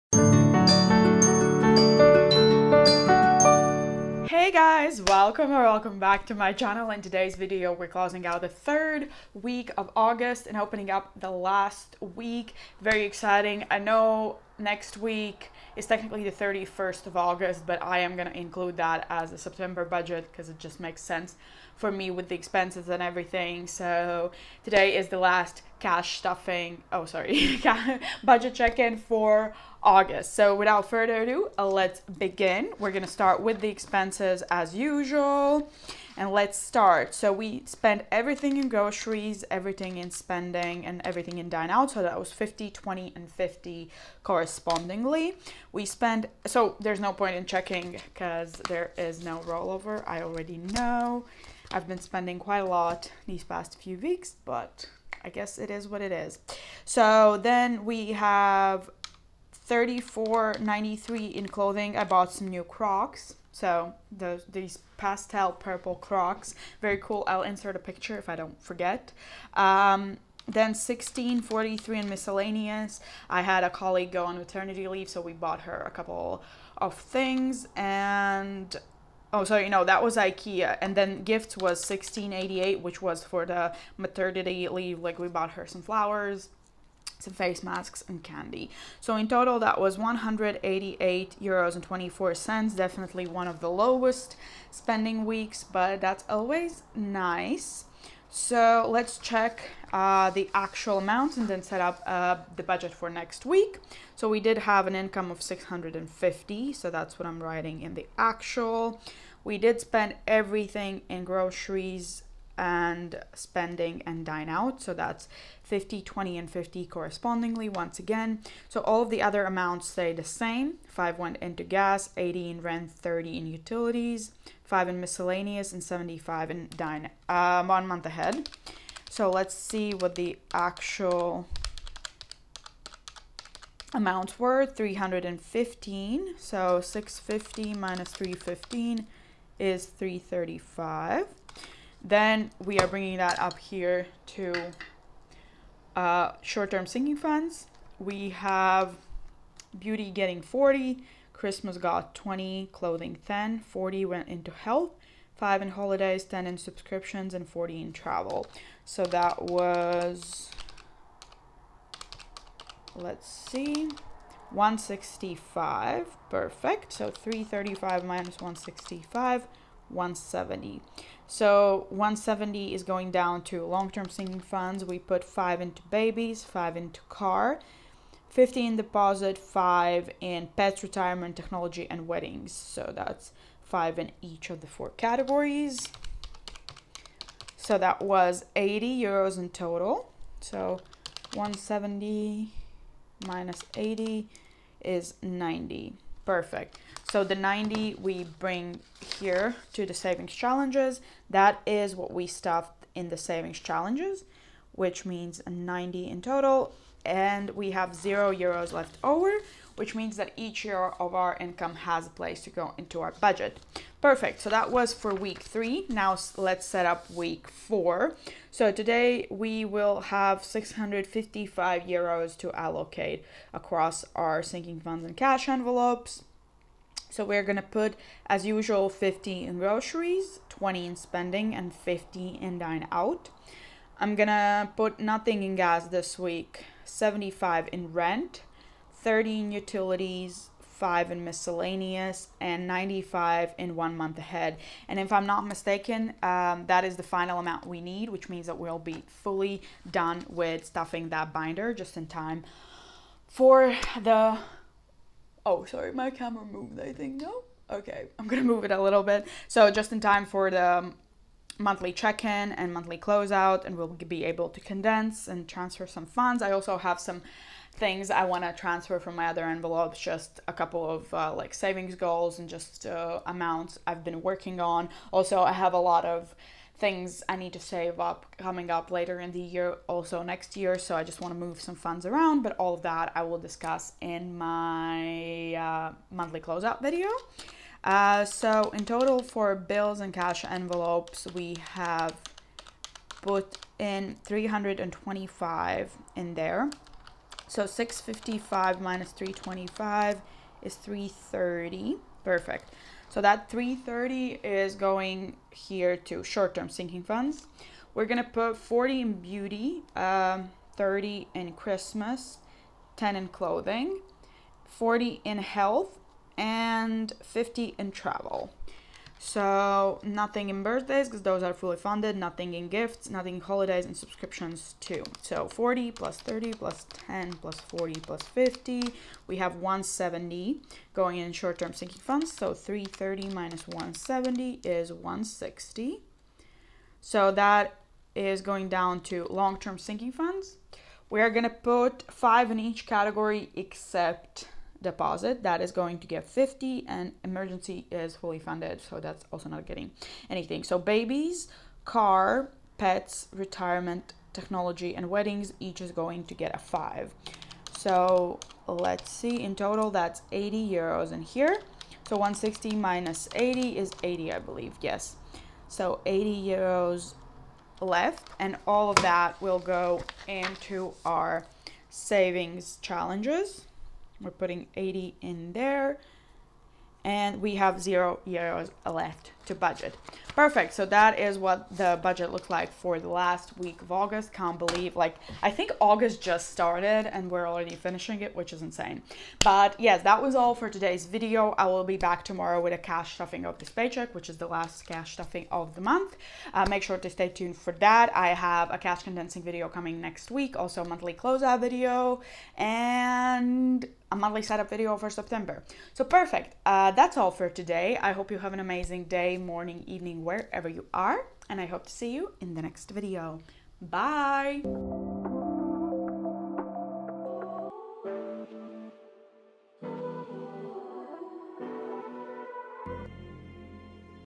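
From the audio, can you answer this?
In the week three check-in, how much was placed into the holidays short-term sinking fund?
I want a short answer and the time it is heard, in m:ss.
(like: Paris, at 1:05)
5, at 2:35.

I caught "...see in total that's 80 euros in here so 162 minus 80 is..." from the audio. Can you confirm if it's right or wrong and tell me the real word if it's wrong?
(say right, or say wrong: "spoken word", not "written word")
wrong: "160", not "162".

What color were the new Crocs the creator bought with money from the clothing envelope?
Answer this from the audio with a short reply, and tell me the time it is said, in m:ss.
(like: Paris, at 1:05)
Pastel purple, at 1:04.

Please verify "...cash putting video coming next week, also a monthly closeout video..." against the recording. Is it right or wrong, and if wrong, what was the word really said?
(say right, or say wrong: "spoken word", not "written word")
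wrong: "condensing", not "putting".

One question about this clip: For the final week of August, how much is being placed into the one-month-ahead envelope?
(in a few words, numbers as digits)
95.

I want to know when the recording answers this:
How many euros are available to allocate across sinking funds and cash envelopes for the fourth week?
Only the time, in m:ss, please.
3:40.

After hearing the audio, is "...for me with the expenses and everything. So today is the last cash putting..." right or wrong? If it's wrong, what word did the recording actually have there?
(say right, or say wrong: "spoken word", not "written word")
wrong: "stuffing", not "putting".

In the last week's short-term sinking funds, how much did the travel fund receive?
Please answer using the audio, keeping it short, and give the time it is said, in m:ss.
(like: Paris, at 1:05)
50, at 5:17.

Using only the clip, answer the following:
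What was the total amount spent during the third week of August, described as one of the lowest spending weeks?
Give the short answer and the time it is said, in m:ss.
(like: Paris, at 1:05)
188.24 euros, at 1:29.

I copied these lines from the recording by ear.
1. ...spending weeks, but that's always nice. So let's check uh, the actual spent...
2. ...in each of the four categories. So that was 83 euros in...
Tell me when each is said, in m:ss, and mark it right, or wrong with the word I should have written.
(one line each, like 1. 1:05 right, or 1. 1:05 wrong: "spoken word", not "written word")
1. 1:34 wrong: "amount", not "spent"
2. 3:03 wrong: "80", not "83".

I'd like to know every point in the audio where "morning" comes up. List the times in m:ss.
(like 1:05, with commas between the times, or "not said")
6:49.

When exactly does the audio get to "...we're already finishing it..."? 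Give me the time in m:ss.
6:27.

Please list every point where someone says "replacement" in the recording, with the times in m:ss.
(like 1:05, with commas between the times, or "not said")
not said.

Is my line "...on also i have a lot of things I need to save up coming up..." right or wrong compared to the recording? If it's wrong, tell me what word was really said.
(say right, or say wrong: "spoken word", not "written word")
right.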